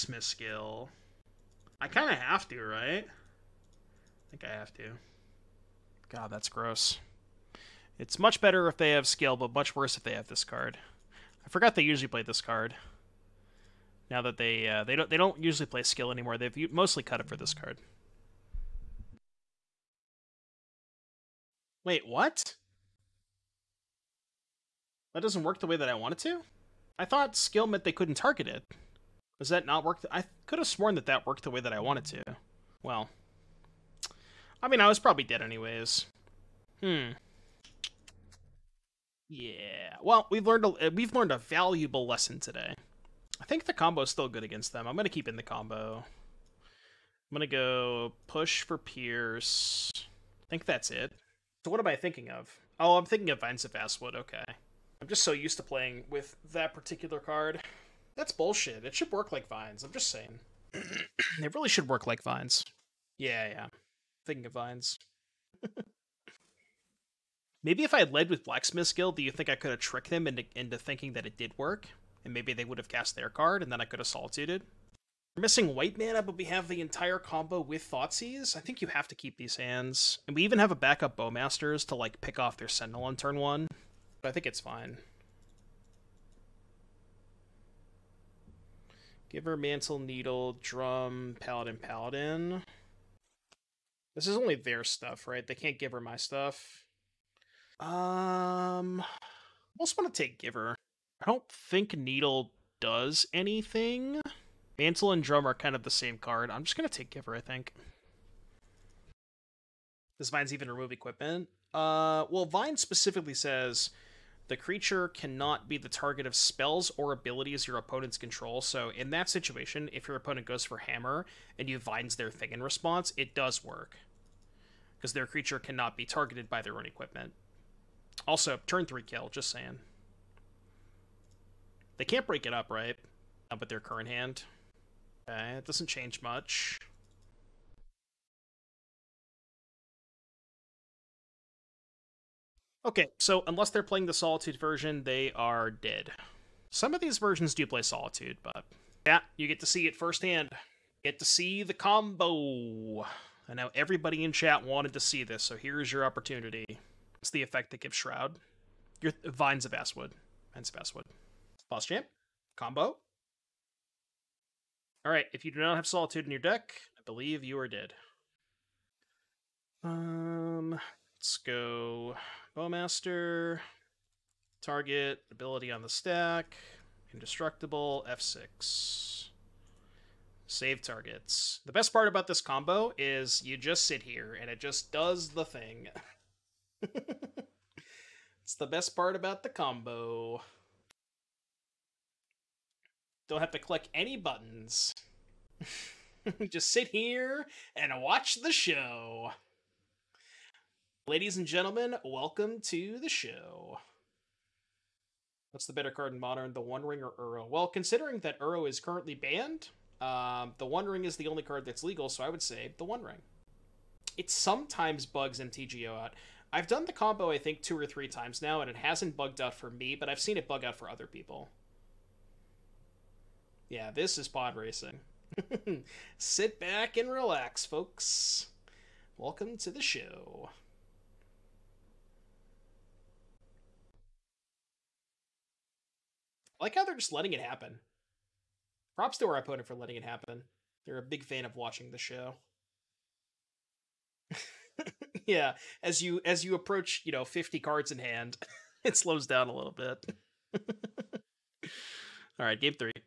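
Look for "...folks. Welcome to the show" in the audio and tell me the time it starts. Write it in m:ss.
3:47.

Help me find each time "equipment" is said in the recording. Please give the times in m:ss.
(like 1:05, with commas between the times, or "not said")
1:50, 2:06.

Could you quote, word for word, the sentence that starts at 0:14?
Now that they uh, they don't they don't usually play skill anymore.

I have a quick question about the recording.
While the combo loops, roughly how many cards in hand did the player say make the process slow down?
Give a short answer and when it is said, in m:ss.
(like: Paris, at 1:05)
50, at 4:07.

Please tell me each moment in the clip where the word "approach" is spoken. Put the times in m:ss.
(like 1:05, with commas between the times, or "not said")
4:06.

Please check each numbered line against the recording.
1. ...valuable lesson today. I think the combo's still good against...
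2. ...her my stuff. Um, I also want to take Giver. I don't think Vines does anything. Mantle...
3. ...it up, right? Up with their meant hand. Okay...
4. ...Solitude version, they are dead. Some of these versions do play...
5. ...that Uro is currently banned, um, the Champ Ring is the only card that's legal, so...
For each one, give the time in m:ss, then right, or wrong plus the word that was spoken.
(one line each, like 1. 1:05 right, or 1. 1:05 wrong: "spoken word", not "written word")
1. 0:41 right
2. 1:35 wrong: "Needle", not "Vines"
3. 2:12 wrong: "current", not "meant"
4. 2:24 right
5. 3:28 wrong: "One", not "Champ".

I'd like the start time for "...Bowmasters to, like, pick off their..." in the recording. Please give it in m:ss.
1:21.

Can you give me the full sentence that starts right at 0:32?
Well, I mean, I was probably dead anyways.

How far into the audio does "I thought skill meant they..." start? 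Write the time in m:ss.
0:26.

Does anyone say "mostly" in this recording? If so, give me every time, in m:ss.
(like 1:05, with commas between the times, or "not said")
0:16.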